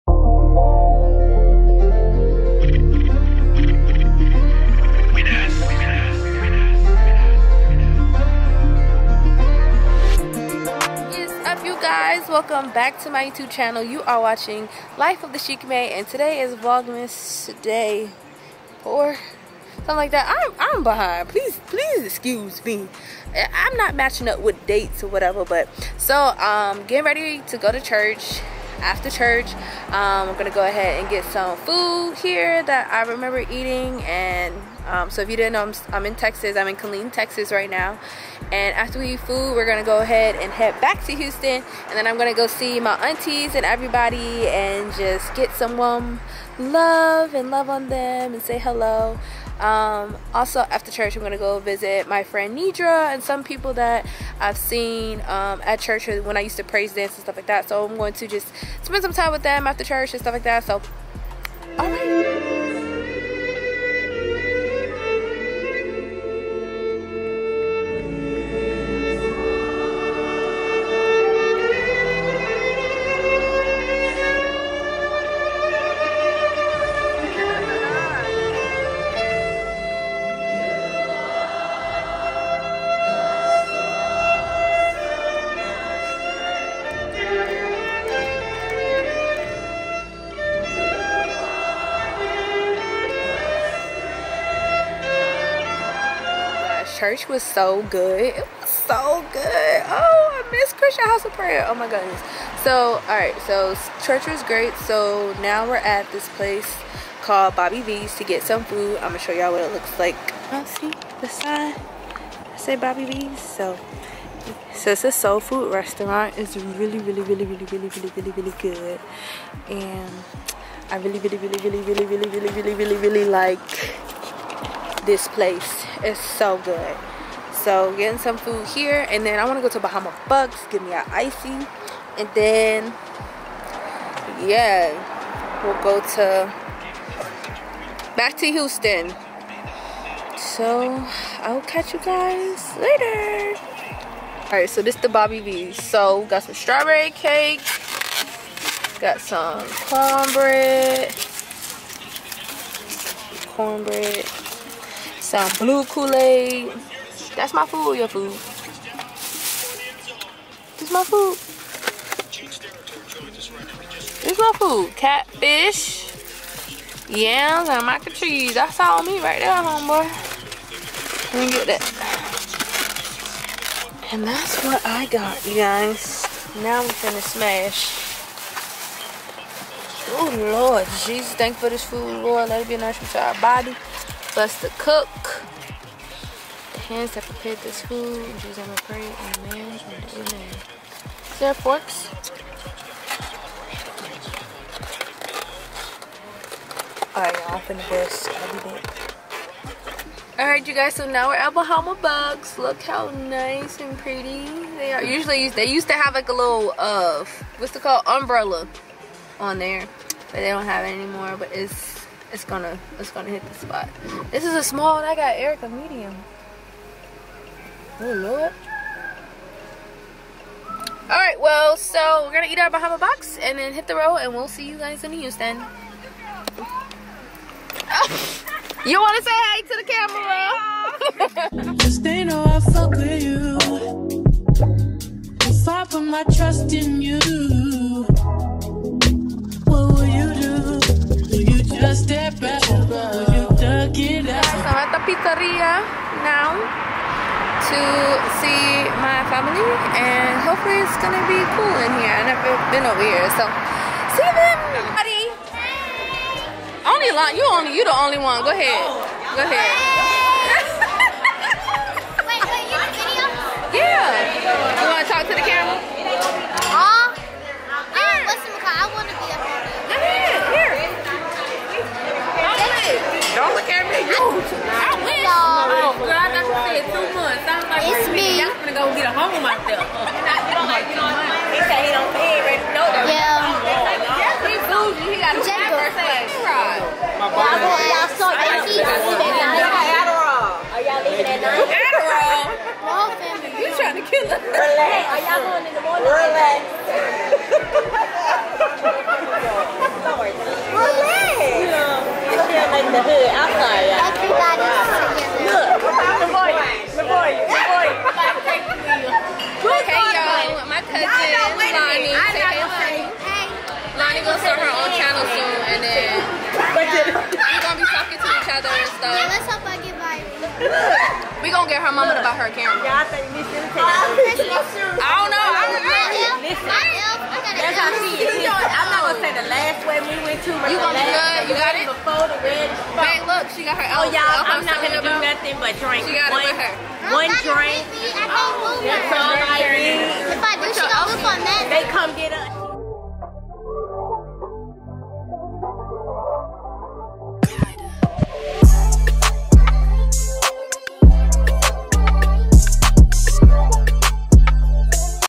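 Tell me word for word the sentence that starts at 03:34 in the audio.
This is a small and I got Erica medium.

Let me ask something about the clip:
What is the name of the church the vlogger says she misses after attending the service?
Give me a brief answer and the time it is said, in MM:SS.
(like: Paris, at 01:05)
Christian House of Prayer, at 01:40.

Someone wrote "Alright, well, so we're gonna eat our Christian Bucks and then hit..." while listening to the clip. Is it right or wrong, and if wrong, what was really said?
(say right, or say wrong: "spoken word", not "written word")
wrong: "Bahama", not "Christian".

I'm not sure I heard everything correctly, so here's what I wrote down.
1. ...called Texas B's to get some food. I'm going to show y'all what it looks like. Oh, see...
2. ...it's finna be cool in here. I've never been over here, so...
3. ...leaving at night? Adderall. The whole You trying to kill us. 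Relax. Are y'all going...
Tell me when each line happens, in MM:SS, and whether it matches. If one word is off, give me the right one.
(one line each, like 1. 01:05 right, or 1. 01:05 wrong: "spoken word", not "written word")
1. 01:47 wrong: "Bobby", not "Texas"
2. 04:10 wrong: "gonna", not "finna"
3. 04:51 right.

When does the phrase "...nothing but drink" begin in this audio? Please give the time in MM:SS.
05:35.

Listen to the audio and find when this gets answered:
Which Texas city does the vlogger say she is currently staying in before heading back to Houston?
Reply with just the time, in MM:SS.
00:36.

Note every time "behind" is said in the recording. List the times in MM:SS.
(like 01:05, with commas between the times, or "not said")
00:20.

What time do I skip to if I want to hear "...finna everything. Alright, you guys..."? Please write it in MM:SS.
03:17.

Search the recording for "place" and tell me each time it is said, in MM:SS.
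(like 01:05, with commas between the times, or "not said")
01:46, 02:05.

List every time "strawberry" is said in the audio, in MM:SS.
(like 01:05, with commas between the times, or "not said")
02:26.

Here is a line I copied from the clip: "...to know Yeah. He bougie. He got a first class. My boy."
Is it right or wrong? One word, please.
right.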